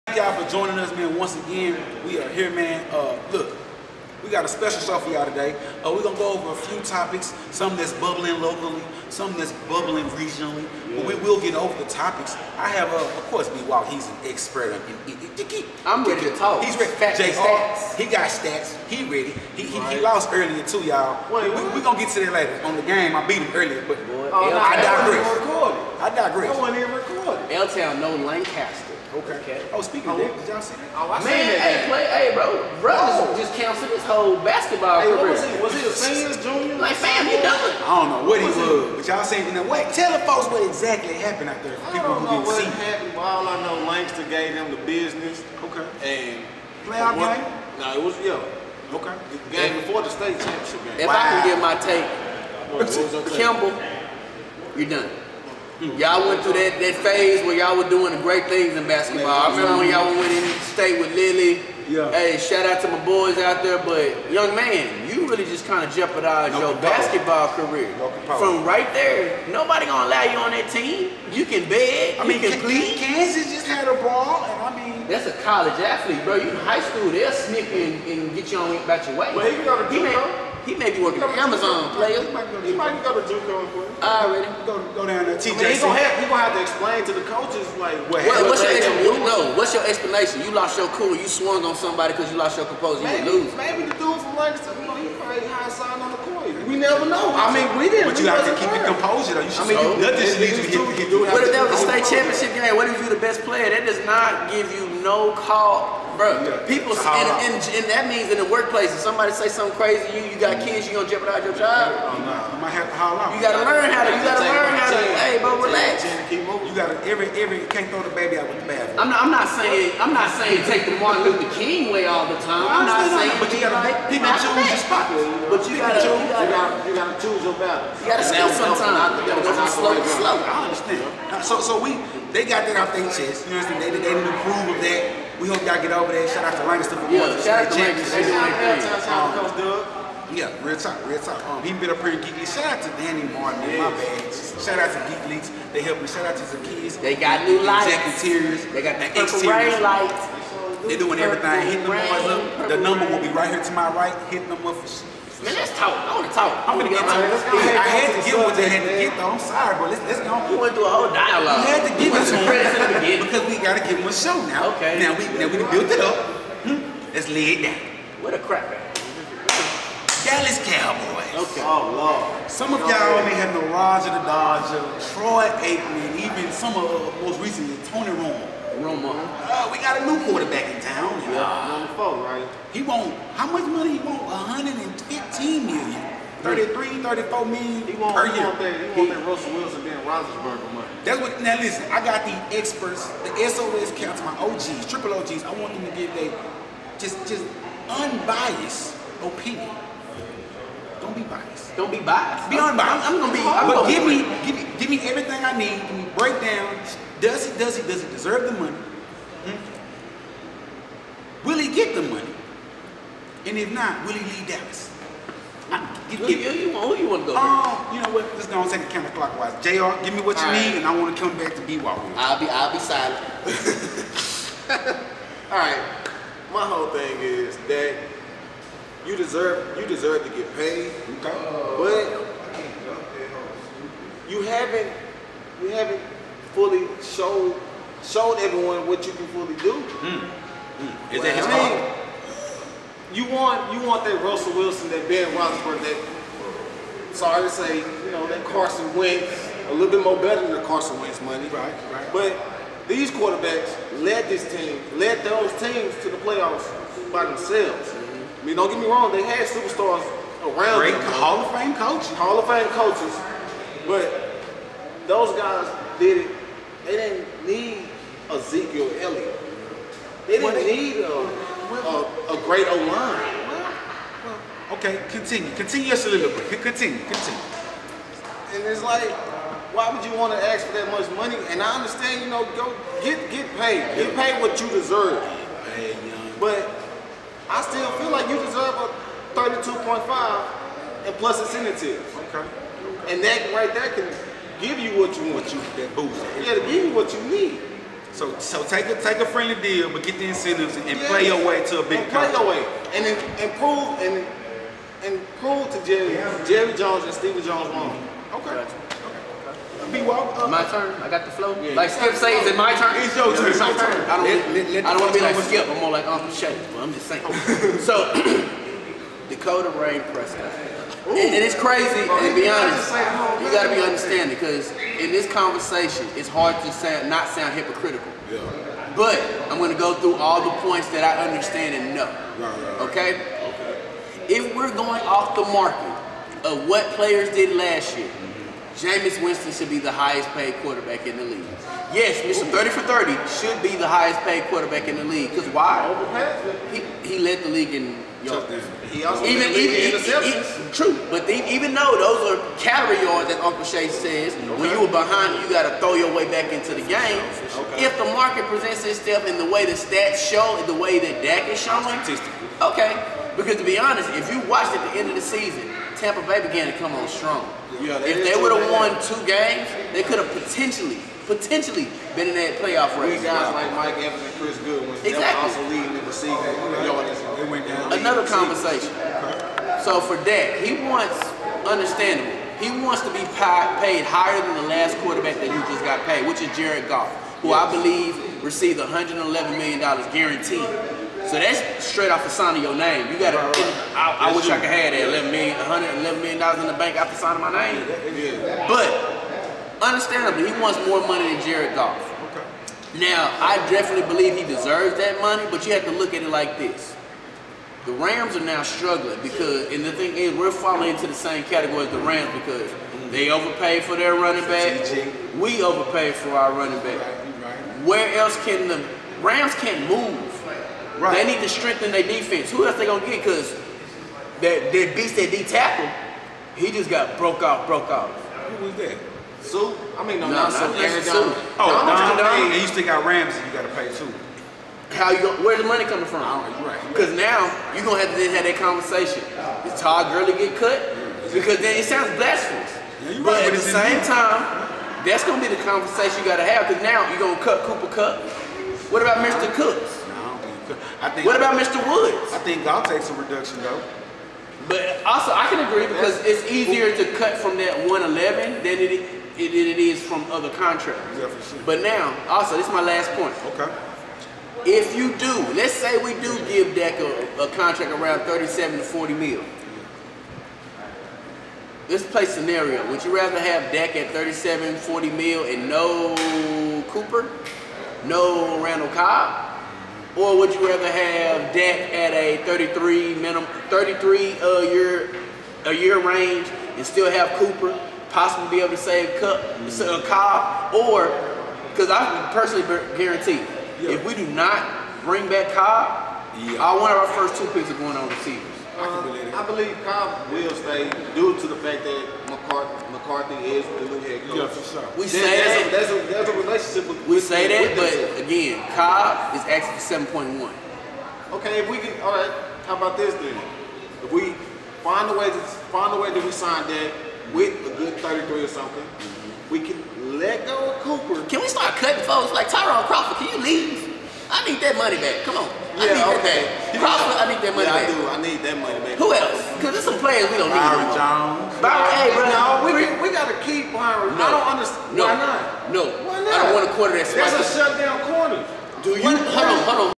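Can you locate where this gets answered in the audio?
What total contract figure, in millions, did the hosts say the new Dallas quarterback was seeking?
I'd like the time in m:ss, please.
3:04.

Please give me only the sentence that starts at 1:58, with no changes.
I'm not, I'm not saying I'm not saying take the Martin Luther King way all the time.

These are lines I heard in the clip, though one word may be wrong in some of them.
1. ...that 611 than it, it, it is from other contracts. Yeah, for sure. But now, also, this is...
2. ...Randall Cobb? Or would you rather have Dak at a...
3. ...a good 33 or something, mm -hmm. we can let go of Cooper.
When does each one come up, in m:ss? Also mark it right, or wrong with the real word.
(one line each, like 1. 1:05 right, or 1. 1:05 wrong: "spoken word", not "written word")
1. 7:37 wrong: "111", not "611"
2. 7:58 right
3. 8:37 right.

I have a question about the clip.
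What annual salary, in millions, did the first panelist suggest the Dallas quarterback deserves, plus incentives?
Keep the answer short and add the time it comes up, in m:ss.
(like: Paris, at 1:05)
32.5 million, at 4:49.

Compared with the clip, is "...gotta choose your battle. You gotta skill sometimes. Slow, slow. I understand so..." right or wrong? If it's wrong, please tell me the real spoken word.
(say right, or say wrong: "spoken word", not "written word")
right.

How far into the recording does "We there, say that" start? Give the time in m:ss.
8:24.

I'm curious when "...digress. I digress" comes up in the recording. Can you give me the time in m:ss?
0:24.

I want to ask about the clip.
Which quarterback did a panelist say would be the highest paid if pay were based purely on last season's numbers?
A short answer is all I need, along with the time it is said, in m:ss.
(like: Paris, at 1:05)
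Jameis Winston, at 5:38.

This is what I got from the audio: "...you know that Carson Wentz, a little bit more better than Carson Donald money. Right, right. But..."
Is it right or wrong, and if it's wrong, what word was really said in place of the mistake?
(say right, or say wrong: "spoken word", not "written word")
wrong: "Wentz", not "Donald".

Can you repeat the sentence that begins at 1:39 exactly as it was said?
I mean, so, nothing should lead you to get.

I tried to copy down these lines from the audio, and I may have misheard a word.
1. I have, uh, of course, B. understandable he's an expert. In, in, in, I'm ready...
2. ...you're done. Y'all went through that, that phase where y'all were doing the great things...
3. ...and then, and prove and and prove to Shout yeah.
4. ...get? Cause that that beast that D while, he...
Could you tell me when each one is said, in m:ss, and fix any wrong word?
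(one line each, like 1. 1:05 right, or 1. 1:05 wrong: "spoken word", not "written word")
1. 0:12 wrong: "while", not "understandable"
2. 0:54 right
3. 5:02 wrong: "Jerry", not "Shout"
4. 7:03 wrong: "tackle", not "while".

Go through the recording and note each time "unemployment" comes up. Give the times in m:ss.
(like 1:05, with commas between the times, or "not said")
not said.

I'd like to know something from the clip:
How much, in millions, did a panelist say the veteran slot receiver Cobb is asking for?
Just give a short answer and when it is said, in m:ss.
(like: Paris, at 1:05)
7.1 million, at 8:30.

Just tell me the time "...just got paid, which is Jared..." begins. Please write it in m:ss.
6:25.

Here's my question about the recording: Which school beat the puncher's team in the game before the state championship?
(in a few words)
Langston.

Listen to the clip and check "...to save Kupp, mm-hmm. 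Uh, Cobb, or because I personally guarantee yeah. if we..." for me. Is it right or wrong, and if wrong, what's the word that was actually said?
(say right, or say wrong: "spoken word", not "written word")
right.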